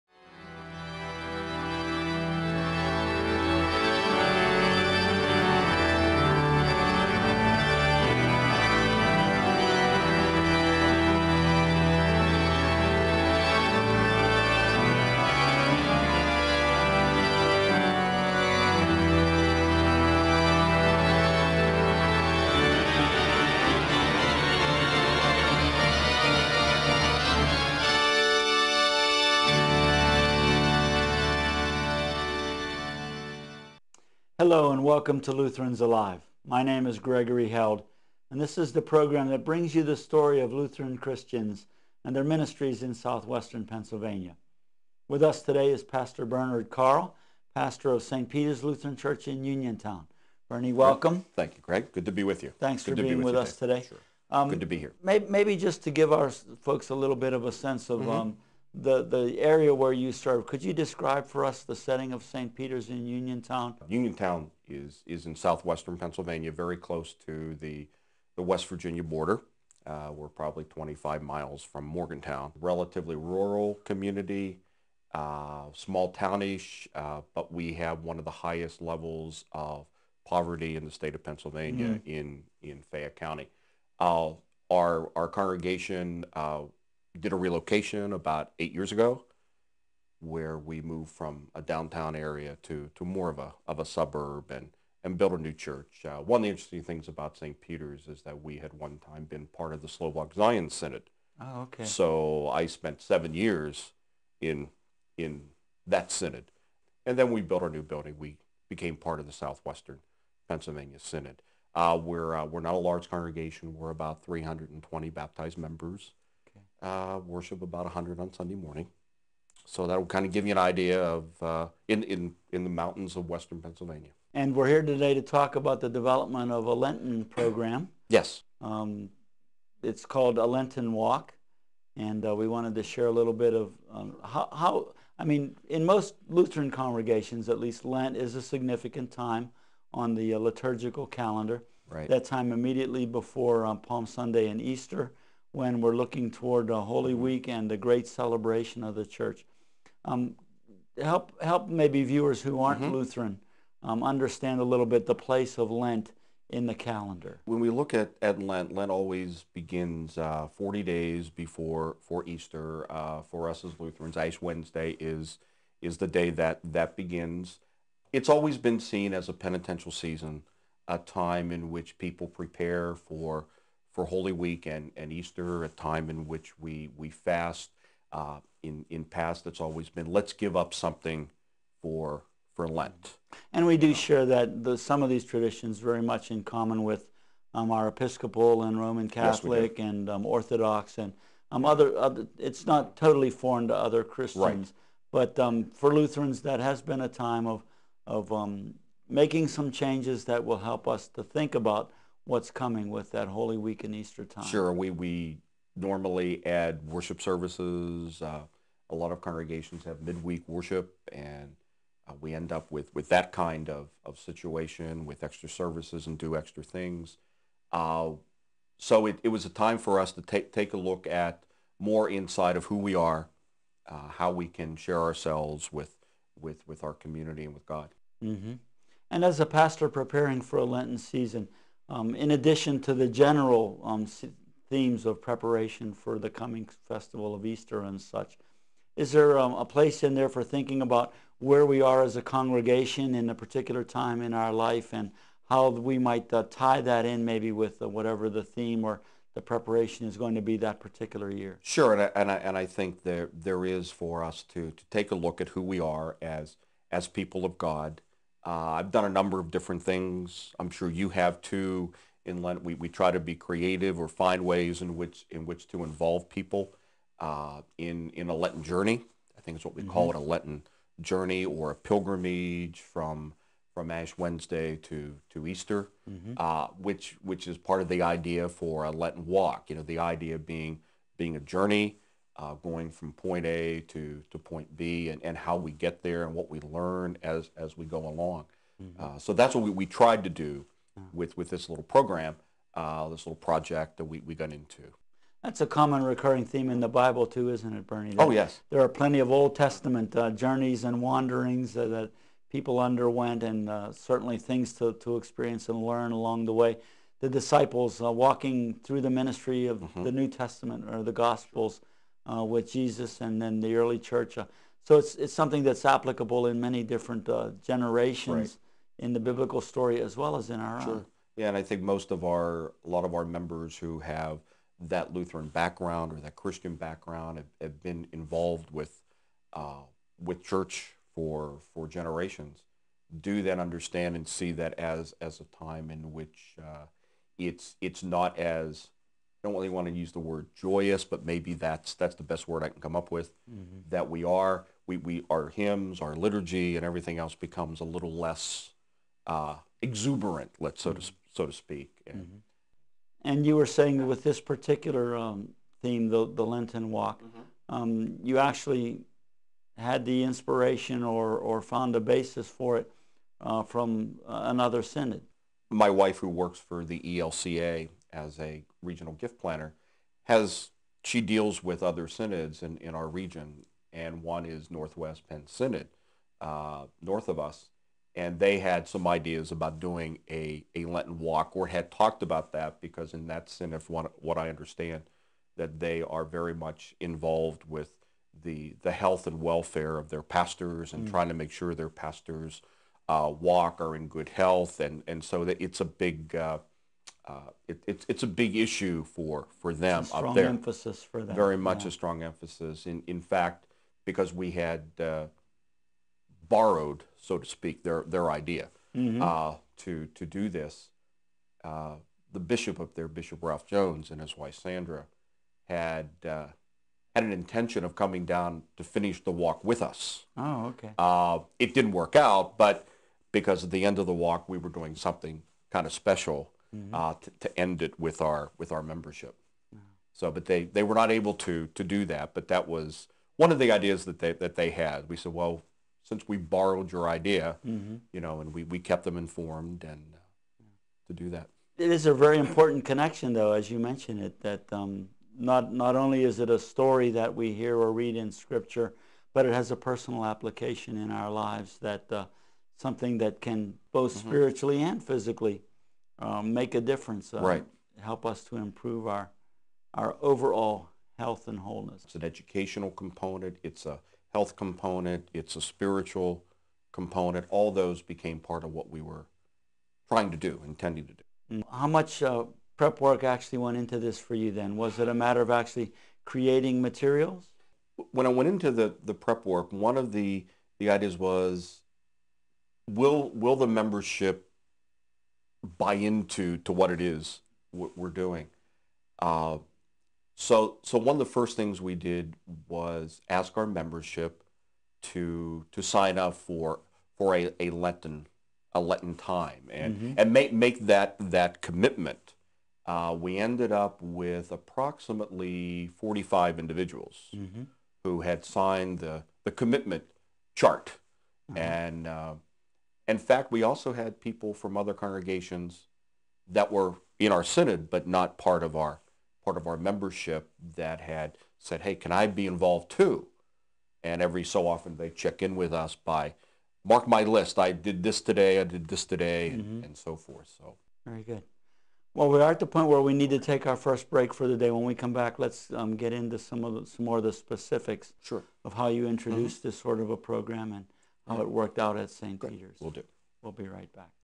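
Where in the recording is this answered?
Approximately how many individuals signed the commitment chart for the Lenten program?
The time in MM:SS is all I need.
08:25.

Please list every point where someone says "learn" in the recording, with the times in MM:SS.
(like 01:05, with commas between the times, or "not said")
04:46, 05:05.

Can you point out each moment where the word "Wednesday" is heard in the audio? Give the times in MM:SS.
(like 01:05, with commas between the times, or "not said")
02:44, 04:34.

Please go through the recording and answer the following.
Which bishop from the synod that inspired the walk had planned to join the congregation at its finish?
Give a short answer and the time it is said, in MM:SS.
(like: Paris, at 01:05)
Ralph Jones, at 06:53.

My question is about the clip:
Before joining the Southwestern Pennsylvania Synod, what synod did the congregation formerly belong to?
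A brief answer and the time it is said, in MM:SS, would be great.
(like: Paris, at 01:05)
Slovak Zion Synod, at 01:39.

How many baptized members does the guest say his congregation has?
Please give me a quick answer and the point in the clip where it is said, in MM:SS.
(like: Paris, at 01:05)
320, at 01:54.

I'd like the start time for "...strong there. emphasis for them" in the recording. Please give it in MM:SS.
06:40.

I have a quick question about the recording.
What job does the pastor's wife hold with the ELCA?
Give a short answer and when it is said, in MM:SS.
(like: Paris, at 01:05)
Regional gift planner, at 06:08.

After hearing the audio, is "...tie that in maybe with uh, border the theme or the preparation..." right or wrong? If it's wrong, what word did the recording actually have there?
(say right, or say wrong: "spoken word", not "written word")
wrong: "whatever", not "border".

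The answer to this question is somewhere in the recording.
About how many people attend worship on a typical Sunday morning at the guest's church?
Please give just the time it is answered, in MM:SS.
01:57.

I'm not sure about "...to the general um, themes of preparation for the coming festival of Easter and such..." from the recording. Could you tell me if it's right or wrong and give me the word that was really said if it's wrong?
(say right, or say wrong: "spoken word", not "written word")
right.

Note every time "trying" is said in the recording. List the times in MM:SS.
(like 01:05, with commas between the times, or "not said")
06:31, 07:50.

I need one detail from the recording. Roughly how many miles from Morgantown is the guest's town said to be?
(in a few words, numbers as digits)
25.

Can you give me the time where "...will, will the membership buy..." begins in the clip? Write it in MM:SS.
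08:02.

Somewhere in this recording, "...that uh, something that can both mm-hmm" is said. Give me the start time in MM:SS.
07:31.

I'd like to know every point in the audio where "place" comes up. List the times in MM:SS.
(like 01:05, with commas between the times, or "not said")
02:35, 03:59.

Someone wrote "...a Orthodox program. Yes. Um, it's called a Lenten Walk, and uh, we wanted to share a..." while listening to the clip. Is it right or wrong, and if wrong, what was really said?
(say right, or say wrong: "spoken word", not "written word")
wrong: "Lenten", not "Orthodox".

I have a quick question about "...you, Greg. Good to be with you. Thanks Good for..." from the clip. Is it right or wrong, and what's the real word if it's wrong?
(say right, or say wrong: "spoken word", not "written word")
right.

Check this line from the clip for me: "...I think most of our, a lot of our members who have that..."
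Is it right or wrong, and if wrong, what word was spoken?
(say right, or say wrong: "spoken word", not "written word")
right.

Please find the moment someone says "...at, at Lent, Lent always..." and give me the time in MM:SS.
02:37.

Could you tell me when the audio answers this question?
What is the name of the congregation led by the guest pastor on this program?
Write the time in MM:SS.
00:48.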